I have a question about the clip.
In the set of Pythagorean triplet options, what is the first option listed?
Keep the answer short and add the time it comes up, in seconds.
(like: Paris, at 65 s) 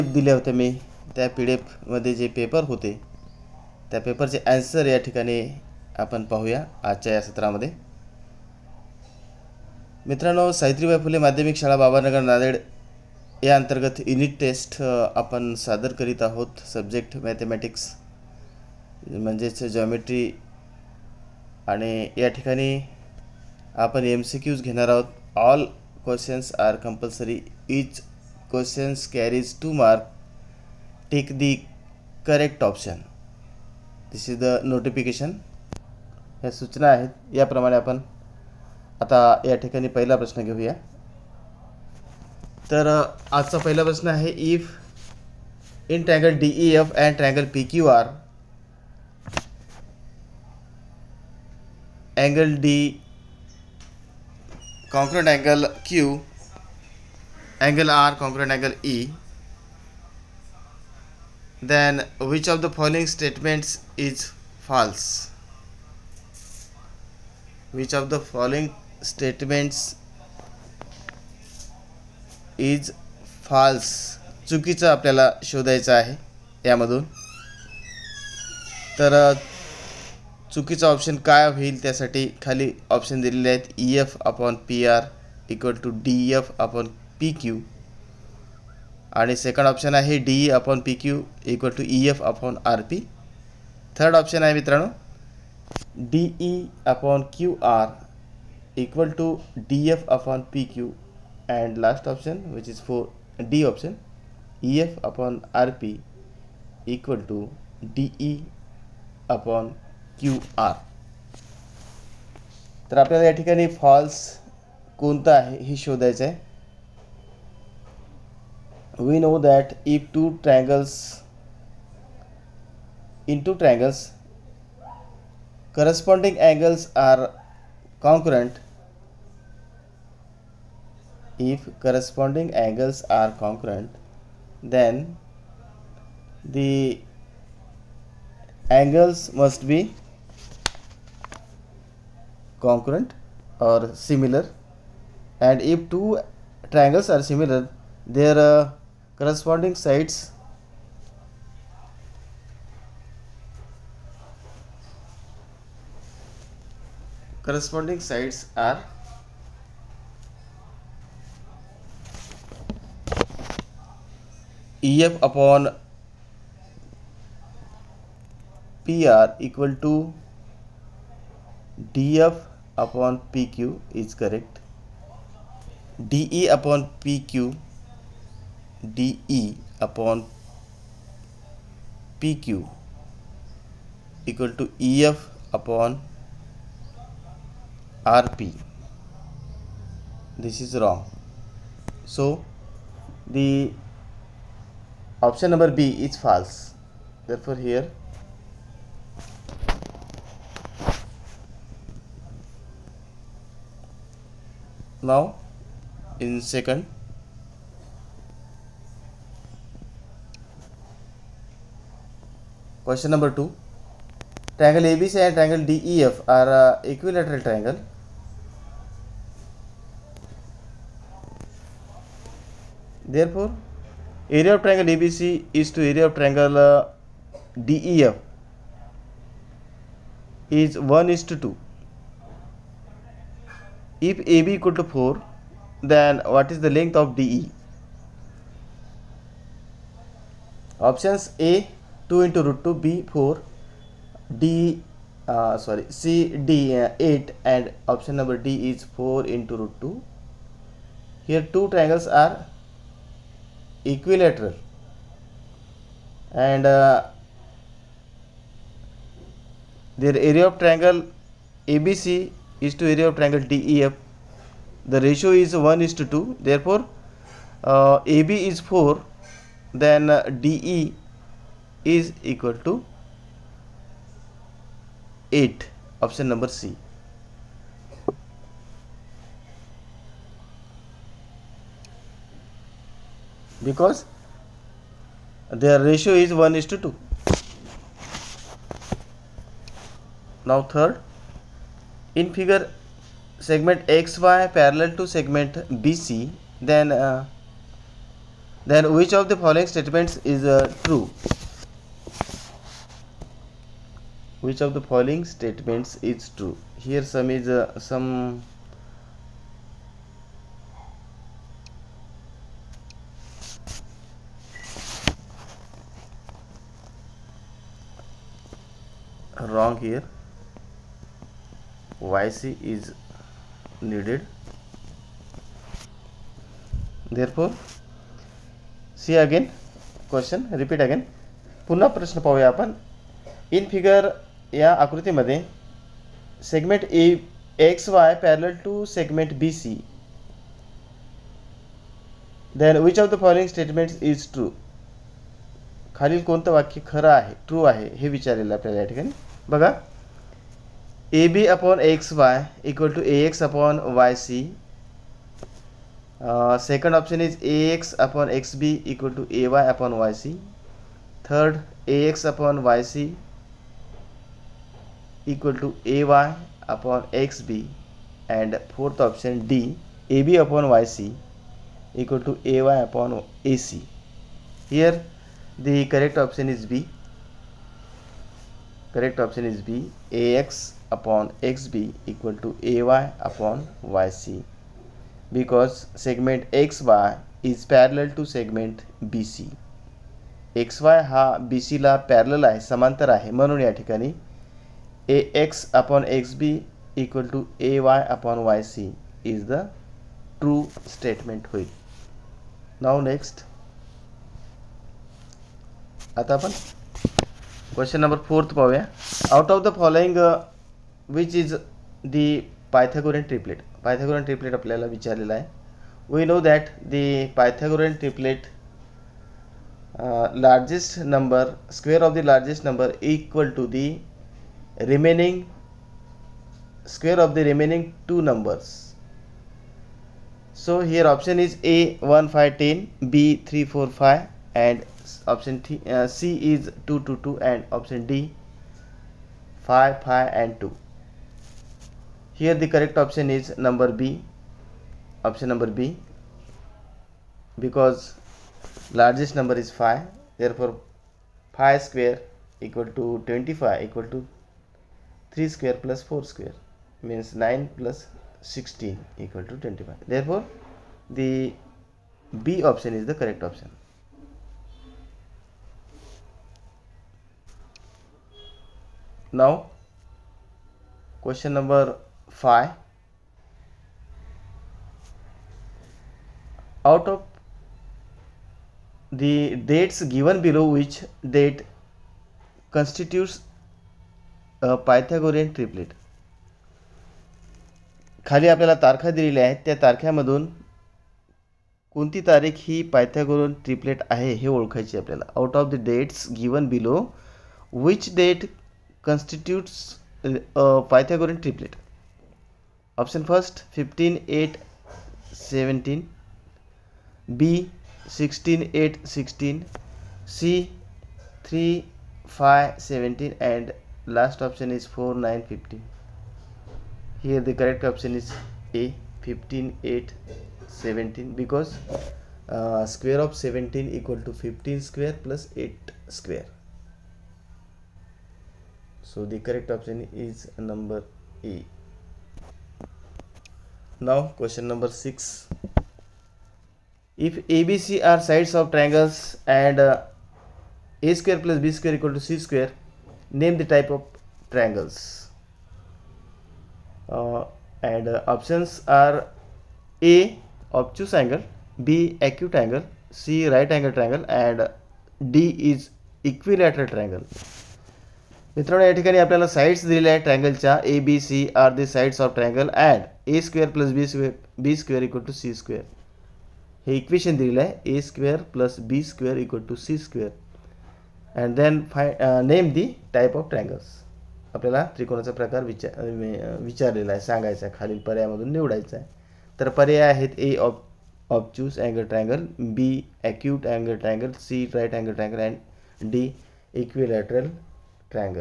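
1, 5, 10, at 431 s.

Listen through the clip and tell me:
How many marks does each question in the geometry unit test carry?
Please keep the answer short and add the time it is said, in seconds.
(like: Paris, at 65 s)
2, at 27 s.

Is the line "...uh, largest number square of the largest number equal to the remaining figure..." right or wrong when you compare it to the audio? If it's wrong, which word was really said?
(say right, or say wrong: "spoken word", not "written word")
wrong: "square", not "figure".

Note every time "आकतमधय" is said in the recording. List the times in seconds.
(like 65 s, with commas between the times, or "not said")
334 s.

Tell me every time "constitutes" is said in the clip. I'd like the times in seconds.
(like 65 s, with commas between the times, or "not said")
482 s, 499 s.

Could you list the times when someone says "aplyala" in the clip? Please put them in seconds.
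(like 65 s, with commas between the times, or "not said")
414 s.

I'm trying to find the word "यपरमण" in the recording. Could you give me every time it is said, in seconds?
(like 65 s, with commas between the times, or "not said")
37 s.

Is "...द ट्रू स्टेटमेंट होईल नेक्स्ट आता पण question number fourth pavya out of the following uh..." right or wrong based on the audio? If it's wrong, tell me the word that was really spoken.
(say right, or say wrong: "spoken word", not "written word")
right.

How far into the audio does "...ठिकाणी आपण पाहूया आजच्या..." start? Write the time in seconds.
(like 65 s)
5 s.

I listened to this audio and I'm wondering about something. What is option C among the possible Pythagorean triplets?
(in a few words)
3, 5, 17.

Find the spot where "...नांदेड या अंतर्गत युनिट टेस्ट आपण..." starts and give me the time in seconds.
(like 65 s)
12 s.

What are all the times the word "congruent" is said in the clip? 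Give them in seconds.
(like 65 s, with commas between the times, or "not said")
133 s, 142 s.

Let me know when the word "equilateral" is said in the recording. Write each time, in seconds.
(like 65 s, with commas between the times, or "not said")
216 s, 253 s, 556 s.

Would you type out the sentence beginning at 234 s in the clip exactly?
If AB equal to 4, then what is the length of DE?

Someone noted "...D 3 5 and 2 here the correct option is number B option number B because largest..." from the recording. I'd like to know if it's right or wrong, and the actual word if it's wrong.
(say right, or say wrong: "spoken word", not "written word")
wrong: "5", not "3".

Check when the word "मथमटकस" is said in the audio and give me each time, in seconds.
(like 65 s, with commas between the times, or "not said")
17 s.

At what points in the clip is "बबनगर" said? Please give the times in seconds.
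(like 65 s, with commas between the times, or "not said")
11 s.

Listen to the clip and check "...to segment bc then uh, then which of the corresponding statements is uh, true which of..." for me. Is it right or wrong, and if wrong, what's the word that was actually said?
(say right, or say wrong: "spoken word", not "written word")
wrong: "following", not "corresponding".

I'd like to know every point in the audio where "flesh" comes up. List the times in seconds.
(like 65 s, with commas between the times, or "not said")
not said.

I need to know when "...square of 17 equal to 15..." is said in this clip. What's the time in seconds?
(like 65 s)
522 s.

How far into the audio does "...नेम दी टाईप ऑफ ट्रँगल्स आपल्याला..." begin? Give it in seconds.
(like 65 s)
572 s.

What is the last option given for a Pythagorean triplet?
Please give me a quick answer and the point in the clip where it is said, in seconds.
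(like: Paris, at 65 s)
4, 9, 15, at 514 s.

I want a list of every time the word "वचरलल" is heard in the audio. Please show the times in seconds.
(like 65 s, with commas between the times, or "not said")
348 s, 576 s.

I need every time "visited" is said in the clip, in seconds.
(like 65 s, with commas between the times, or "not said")
not said.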